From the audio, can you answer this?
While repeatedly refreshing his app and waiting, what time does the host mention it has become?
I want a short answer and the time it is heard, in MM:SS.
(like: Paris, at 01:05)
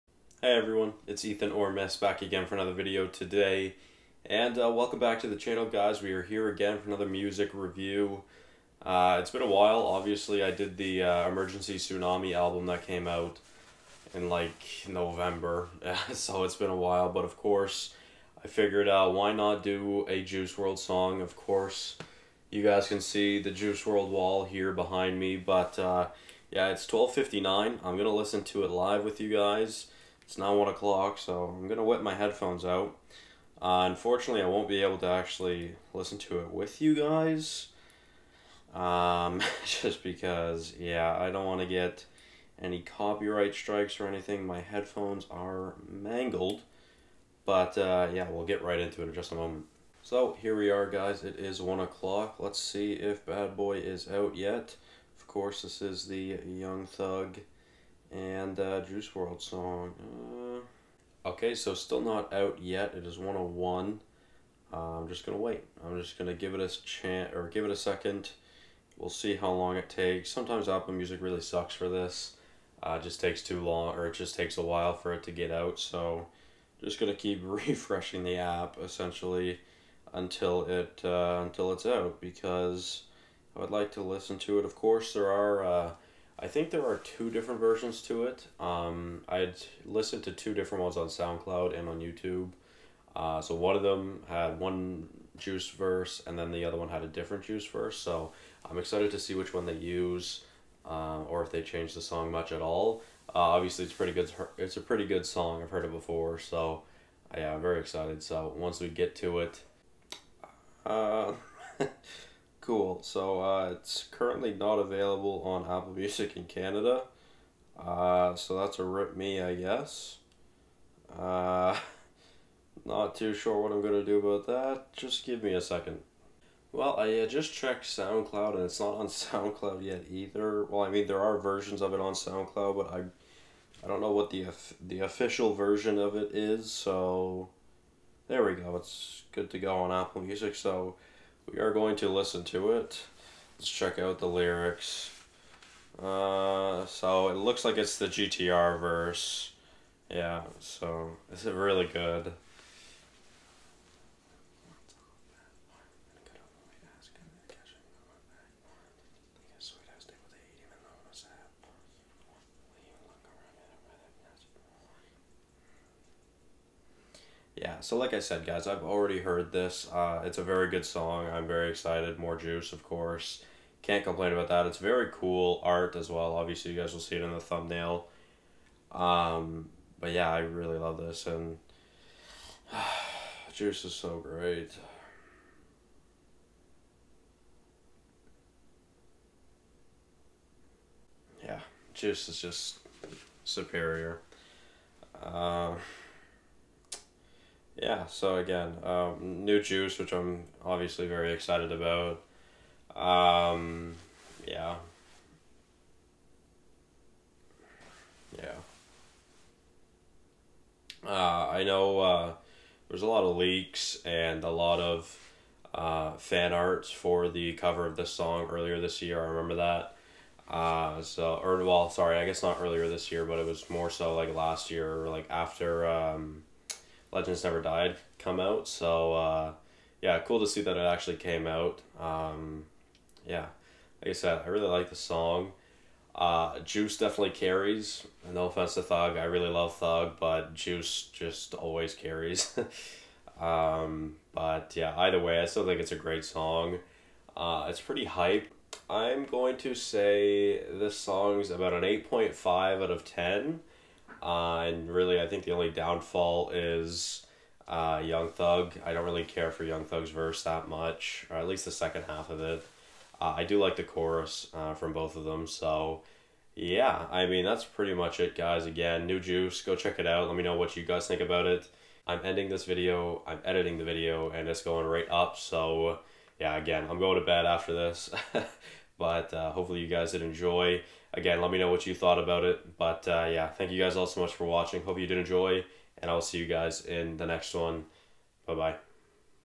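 1:01, at 01:03.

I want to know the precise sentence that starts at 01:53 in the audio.
So uh, it's currently not available on Apple Music in Canada.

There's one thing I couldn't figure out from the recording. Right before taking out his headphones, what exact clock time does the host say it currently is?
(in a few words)
12:59.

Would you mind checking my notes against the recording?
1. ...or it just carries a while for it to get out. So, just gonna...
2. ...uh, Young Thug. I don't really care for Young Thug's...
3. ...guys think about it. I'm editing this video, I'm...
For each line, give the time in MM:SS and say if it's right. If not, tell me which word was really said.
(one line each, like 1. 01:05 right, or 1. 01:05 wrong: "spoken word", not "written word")
1. 01:13 wrong: "takes", not "carries"
2. 04:17 right
3. 04:30 wrong: "ending", not "editing".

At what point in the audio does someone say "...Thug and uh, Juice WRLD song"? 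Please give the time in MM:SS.
00:56.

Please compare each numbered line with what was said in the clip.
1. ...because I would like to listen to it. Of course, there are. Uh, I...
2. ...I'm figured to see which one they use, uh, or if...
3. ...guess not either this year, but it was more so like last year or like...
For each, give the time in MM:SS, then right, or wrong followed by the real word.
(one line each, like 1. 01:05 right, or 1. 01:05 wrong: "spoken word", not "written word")
1. 01:22 right
2. 01:38 wrong: "excited", not "figured"
3. 03:42 wrong: "earlier", not "either".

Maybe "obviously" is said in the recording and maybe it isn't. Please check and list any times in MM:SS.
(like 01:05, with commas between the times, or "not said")
00:09, 01:43, 02:56, 03:20.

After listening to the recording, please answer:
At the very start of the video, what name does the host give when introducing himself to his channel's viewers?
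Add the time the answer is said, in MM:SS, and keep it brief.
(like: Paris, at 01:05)
Ethan Ormes, at 00:01.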